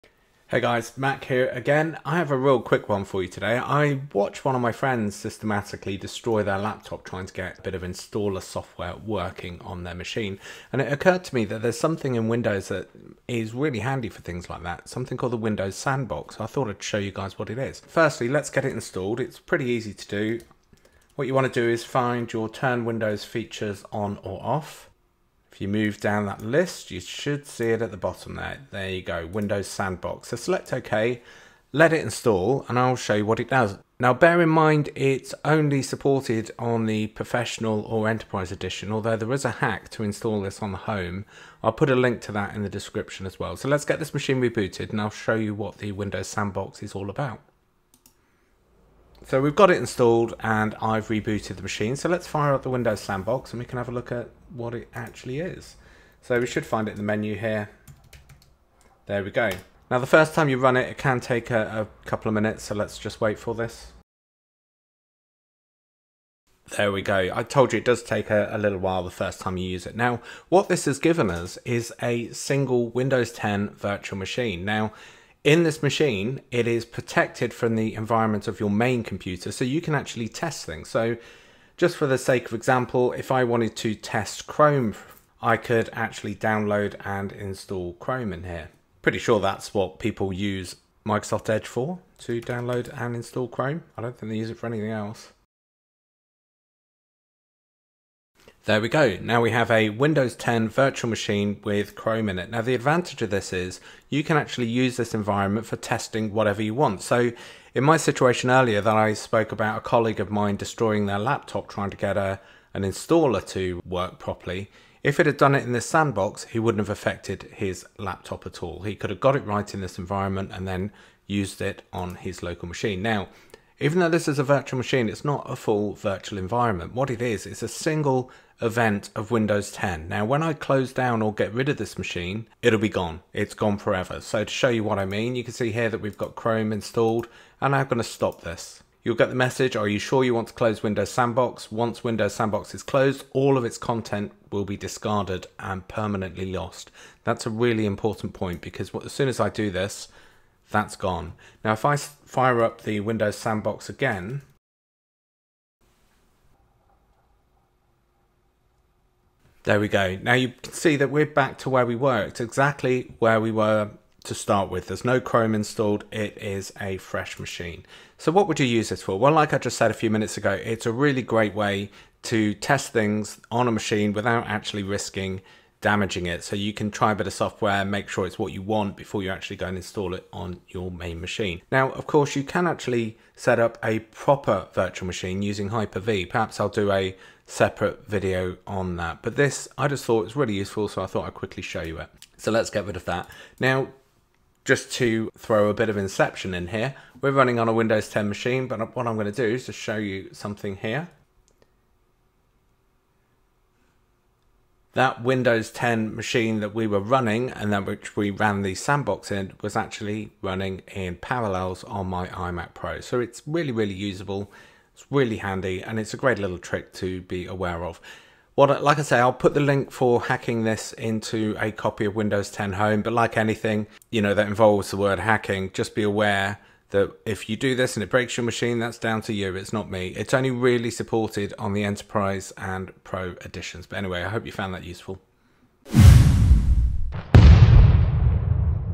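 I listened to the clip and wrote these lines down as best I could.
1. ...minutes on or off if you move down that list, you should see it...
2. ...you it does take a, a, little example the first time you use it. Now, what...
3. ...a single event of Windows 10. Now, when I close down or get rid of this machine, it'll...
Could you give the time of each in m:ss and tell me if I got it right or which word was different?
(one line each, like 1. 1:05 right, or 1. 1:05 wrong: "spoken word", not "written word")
1. 0:23 wrong: "features", not "minutes"
2. 1:07 wrong: "while", not "example"
3. 2:07 right.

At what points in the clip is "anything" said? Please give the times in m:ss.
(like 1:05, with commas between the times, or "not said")
1:34, 3:43.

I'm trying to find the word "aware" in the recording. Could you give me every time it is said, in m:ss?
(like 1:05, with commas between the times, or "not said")
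3:37, 3:46.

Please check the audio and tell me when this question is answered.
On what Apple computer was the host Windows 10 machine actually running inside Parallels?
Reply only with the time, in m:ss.
3:32.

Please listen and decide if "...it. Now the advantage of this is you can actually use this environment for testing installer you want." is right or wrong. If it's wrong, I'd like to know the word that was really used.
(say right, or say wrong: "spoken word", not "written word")
wrong: "whatever", not "installer".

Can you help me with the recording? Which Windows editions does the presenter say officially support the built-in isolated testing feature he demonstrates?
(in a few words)
Professional or Enterprise.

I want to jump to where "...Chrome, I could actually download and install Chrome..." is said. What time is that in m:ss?
1:24.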